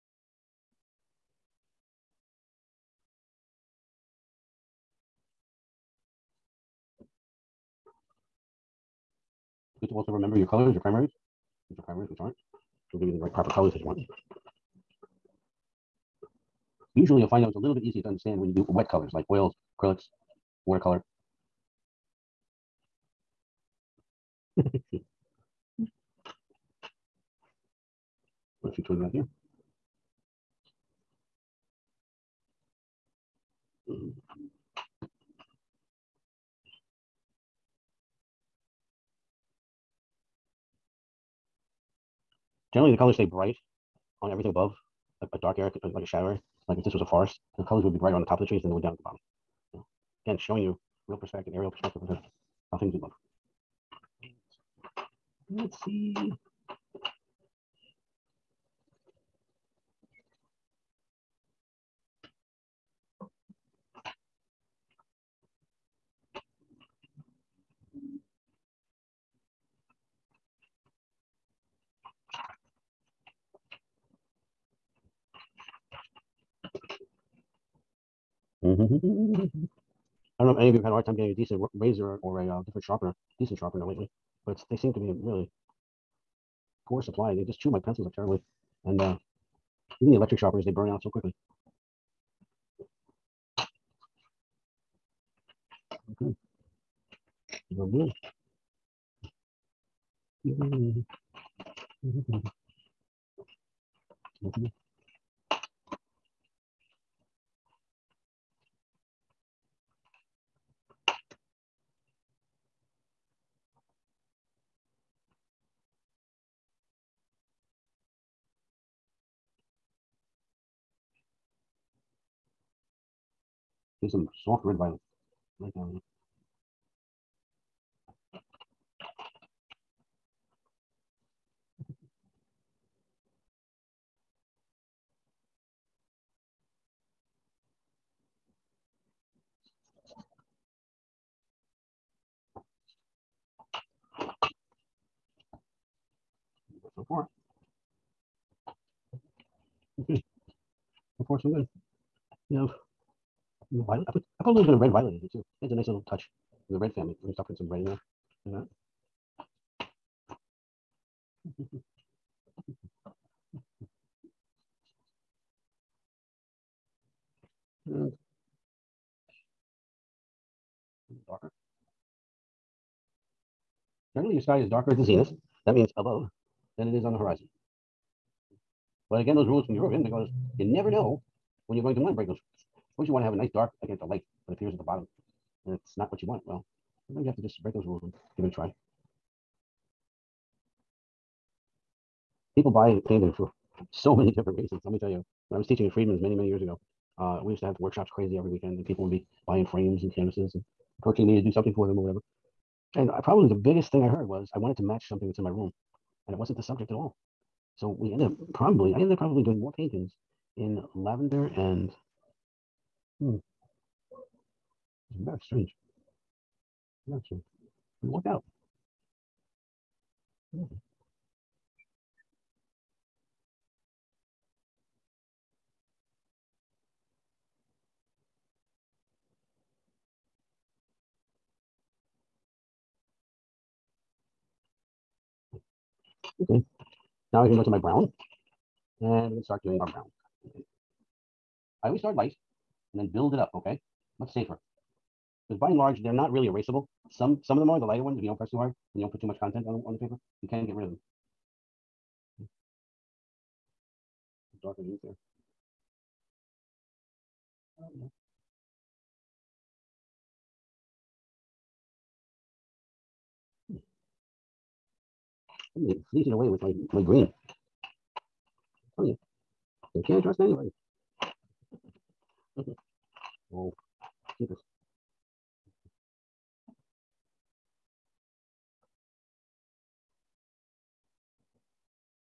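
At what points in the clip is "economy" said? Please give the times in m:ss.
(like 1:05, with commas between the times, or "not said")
not said.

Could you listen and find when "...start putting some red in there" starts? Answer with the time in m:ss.
2:37.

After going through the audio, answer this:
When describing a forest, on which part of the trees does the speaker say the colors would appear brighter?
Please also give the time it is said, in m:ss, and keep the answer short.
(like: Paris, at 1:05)
The top of the trees, at 0:48.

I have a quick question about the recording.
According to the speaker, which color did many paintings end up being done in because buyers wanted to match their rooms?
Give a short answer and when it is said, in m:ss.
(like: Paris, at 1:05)
Lavender, at 3:30.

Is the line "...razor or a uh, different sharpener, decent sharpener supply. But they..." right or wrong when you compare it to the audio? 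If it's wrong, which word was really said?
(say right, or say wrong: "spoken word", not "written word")
wrong: "lately", not "supply".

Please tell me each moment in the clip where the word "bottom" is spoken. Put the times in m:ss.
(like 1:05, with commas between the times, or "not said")
0:49, 3:04.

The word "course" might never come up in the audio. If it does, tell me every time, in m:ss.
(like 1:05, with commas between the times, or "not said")
2:31, 3:02.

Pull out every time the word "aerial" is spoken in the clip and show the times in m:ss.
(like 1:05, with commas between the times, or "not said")
0:51.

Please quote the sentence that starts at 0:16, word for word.
Usually you'll find those a little bit easier to understand when you do wet colors like oils, acrylics, watercolor.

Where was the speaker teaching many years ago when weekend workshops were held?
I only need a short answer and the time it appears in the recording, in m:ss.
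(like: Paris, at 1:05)
Freedman's, at 3:15.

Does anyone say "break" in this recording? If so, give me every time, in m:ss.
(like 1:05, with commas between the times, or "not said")
3:02, 3:07.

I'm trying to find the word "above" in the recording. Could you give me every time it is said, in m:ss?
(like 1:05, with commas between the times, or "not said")
0:44, 2:55.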